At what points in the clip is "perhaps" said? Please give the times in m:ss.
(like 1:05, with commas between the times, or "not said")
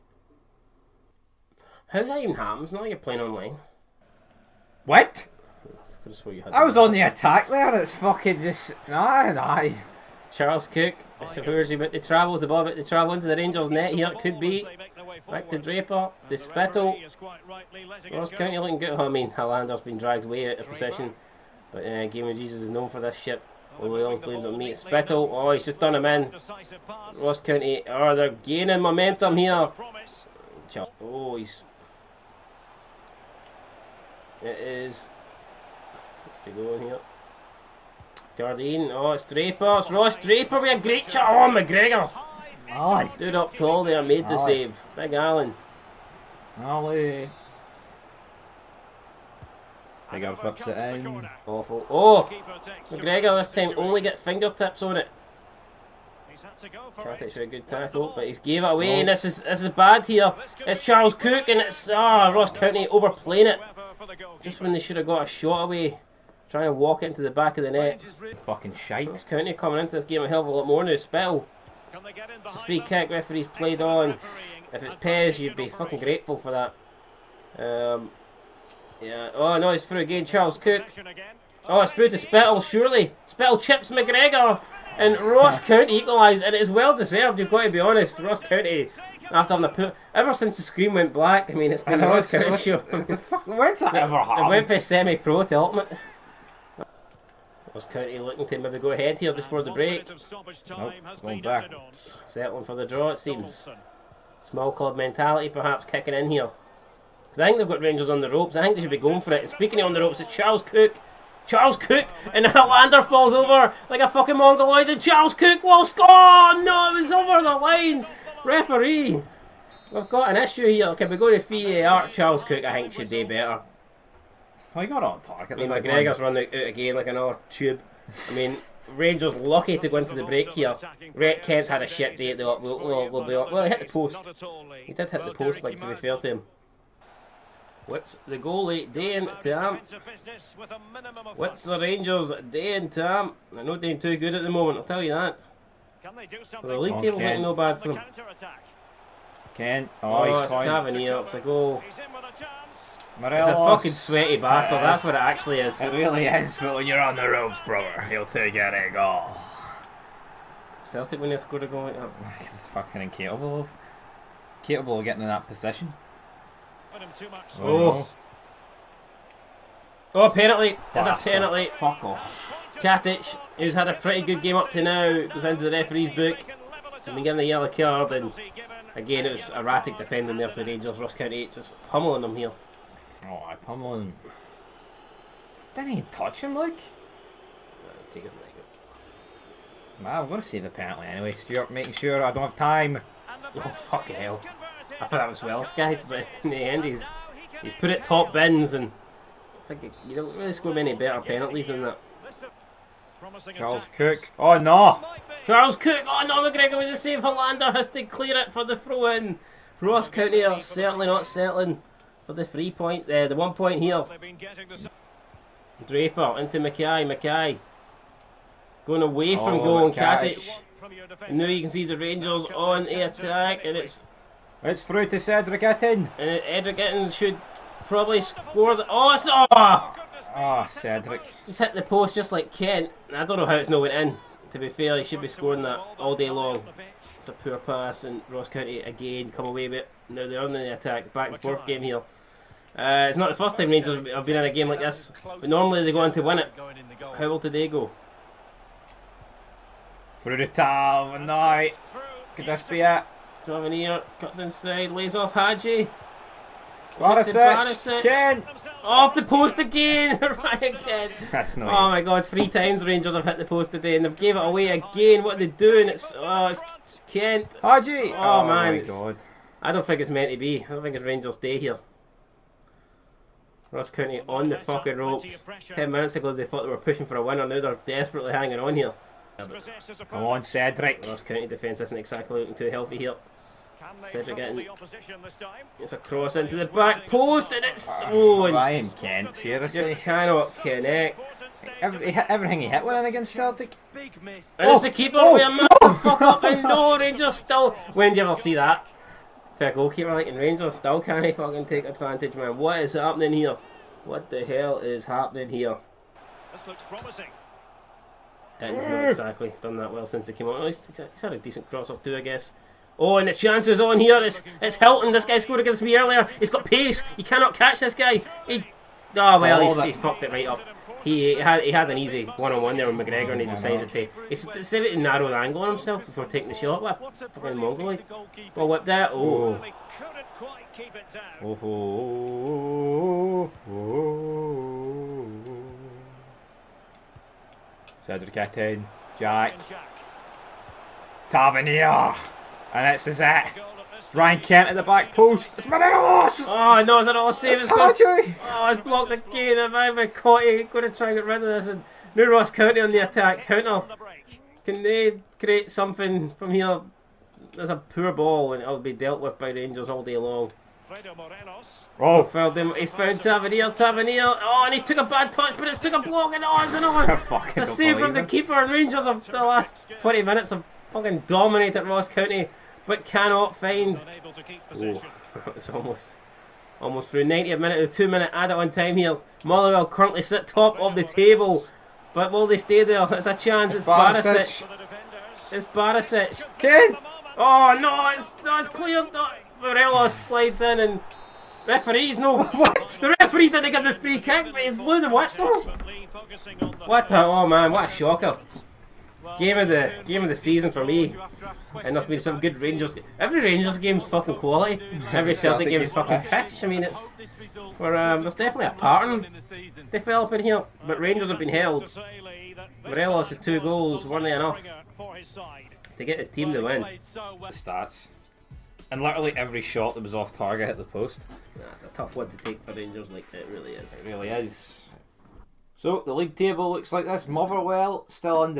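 1:45.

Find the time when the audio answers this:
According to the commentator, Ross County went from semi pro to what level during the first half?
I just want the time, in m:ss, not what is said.
1:35.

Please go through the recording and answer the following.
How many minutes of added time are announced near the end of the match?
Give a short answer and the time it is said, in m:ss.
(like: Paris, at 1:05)
2, at 6:17.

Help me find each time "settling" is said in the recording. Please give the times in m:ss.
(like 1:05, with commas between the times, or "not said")
1:42, 3:31.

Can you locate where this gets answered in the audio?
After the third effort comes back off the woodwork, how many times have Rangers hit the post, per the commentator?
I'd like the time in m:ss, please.
4:22.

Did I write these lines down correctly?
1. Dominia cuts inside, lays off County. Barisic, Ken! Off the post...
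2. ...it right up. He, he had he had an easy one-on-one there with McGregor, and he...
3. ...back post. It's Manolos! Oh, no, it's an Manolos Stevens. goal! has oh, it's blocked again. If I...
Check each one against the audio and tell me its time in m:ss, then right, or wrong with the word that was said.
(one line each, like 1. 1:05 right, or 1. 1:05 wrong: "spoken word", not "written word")
1. 4:13 wrong: "Hagi", not "County"
2. 5:20 right
3. 5:44 right.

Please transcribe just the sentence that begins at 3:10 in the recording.
Nah, I'm going to save the penalty anyway, Stuart, making sure I don't have time.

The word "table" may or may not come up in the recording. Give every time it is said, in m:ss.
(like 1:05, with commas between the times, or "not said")
2:26, 6:21, 7:06.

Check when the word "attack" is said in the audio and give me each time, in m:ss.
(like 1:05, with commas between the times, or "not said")
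0:07, 3:43, 4:00, 5:52.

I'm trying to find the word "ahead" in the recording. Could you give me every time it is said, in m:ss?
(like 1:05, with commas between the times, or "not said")
1:38.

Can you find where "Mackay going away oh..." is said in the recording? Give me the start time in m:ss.
3:37.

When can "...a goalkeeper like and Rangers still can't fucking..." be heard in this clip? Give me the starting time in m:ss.
4:59.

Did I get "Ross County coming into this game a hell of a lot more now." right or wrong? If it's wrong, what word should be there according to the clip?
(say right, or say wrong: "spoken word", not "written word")
right.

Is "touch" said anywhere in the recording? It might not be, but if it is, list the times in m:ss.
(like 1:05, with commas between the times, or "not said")
3:06, 6:05.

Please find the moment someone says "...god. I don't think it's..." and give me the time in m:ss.
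4:28.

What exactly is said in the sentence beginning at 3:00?
Ross County just pummeling him here.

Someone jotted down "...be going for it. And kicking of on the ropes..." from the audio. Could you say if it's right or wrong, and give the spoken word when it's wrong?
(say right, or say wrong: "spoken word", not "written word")
wrong: "speaking", not "kicking".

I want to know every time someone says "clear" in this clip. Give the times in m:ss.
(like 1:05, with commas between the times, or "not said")
3:28, 6:28.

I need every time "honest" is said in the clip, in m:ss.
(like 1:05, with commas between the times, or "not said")
1:27.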